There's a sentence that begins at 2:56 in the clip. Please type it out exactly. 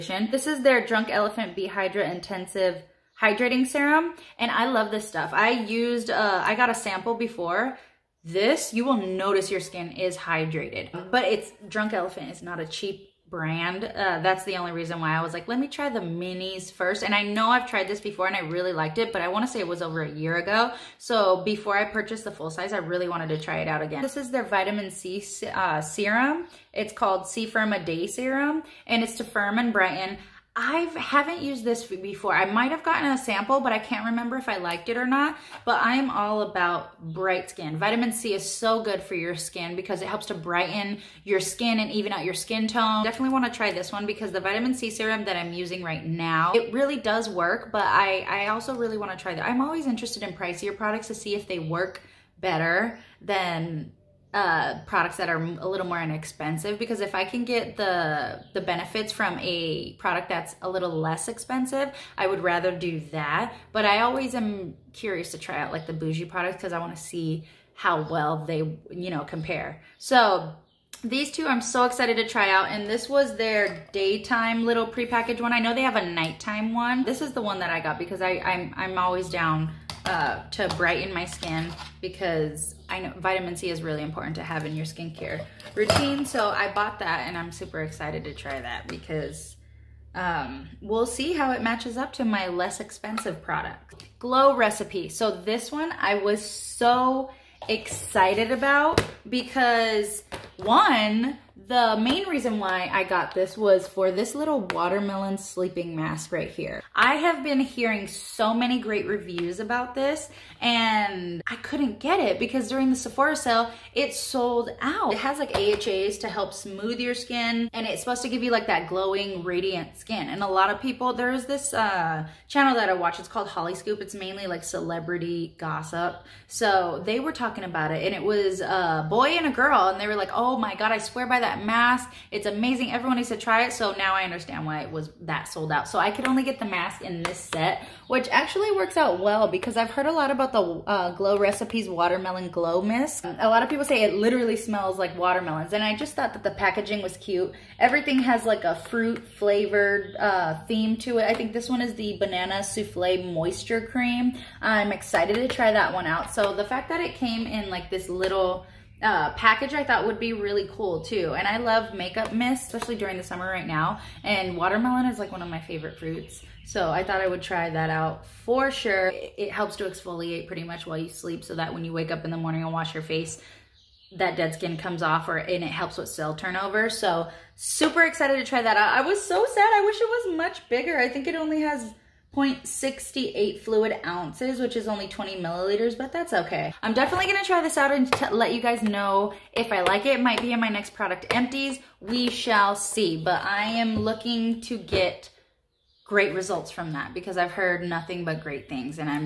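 So super excited to try that out.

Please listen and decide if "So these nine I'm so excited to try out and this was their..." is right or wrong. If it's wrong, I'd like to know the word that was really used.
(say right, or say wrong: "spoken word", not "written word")
wrong: "two", not "nine".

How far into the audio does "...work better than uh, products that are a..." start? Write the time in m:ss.
0:51.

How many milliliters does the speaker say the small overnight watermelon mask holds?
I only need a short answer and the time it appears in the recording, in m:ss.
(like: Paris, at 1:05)
20 milliliters, at 3:05.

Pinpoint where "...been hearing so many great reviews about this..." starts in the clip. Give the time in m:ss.
1:47.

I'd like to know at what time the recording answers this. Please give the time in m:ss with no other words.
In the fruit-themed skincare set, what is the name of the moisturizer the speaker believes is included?
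2:32.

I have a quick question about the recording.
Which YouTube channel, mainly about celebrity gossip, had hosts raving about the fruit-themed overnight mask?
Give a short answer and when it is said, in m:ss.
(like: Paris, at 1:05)
Hollyscoop, at 2:03.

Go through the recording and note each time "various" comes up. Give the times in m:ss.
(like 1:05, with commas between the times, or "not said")
not said.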